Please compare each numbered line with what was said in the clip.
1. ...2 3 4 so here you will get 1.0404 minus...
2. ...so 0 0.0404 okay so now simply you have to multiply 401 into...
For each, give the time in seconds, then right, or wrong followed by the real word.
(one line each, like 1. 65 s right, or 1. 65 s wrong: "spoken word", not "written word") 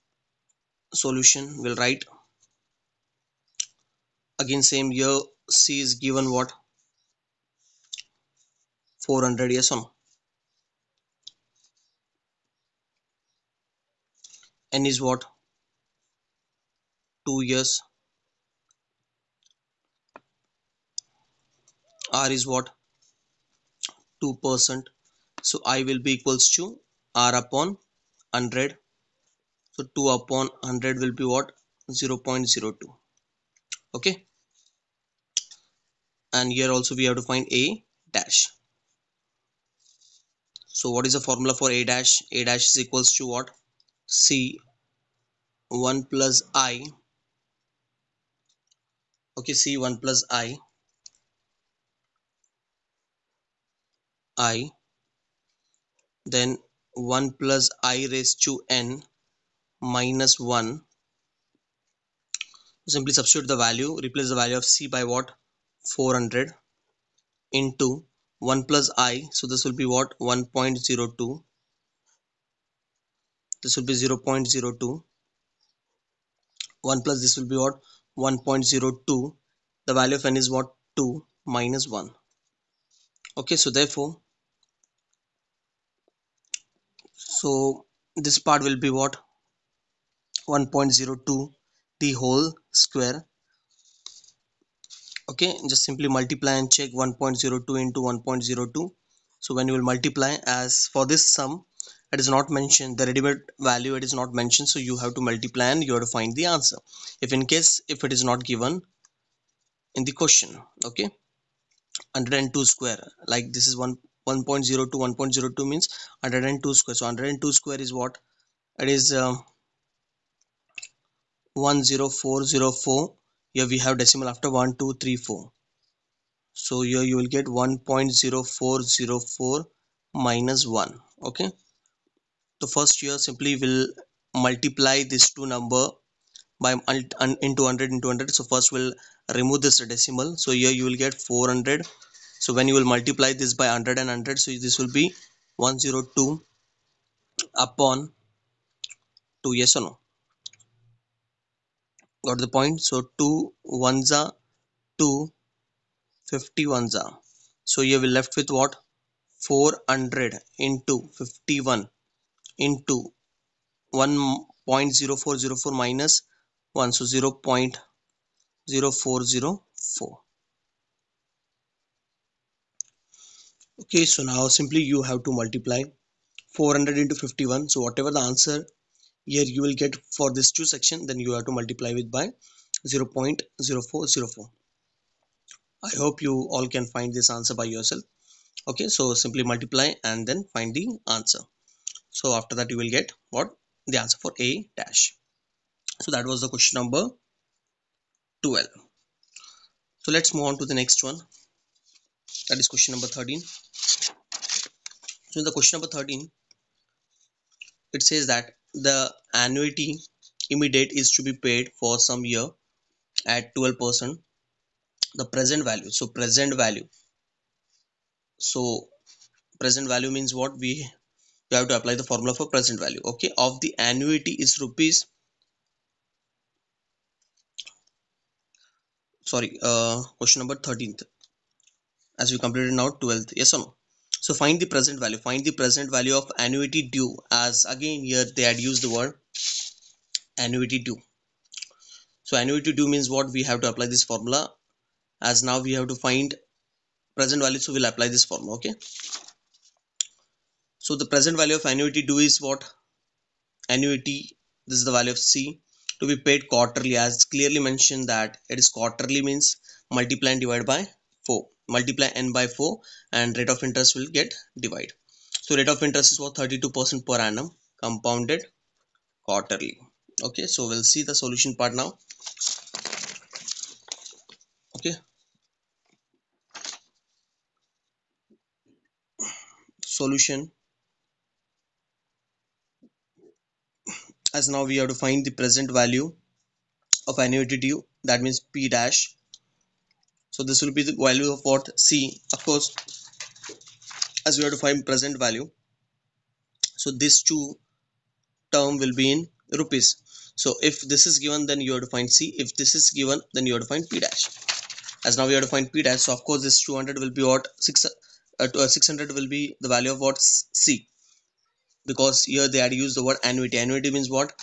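1. 124 s right
2. 166 s wrong: "400", not "401".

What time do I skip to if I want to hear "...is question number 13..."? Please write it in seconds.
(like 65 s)
202 s.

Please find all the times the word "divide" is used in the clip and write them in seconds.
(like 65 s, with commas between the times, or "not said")
260 s, 264 s.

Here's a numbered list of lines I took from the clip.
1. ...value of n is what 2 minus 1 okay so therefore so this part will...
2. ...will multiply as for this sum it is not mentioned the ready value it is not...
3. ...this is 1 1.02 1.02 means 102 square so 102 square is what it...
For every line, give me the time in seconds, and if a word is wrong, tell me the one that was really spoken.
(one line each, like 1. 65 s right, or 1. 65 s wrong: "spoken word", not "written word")
1. 79 s right
2. 99 s right
3. 113 s right.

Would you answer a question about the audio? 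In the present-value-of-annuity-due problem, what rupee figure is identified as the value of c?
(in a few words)
600.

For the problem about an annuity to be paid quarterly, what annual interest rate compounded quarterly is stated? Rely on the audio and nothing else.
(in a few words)
32%.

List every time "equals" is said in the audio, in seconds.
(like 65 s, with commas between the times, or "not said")
26 s, 42 s.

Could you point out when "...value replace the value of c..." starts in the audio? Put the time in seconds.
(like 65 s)
63 s.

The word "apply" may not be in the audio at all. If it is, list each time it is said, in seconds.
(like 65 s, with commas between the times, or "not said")
221 s, 243 s, 247 s.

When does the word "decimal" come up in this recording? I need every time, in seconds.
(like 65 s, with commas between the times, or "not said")
123 s, 139 s.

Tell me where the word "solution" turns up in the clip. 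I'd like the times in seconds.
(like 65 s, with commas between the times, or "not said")
0 s, 271 s, 279 s.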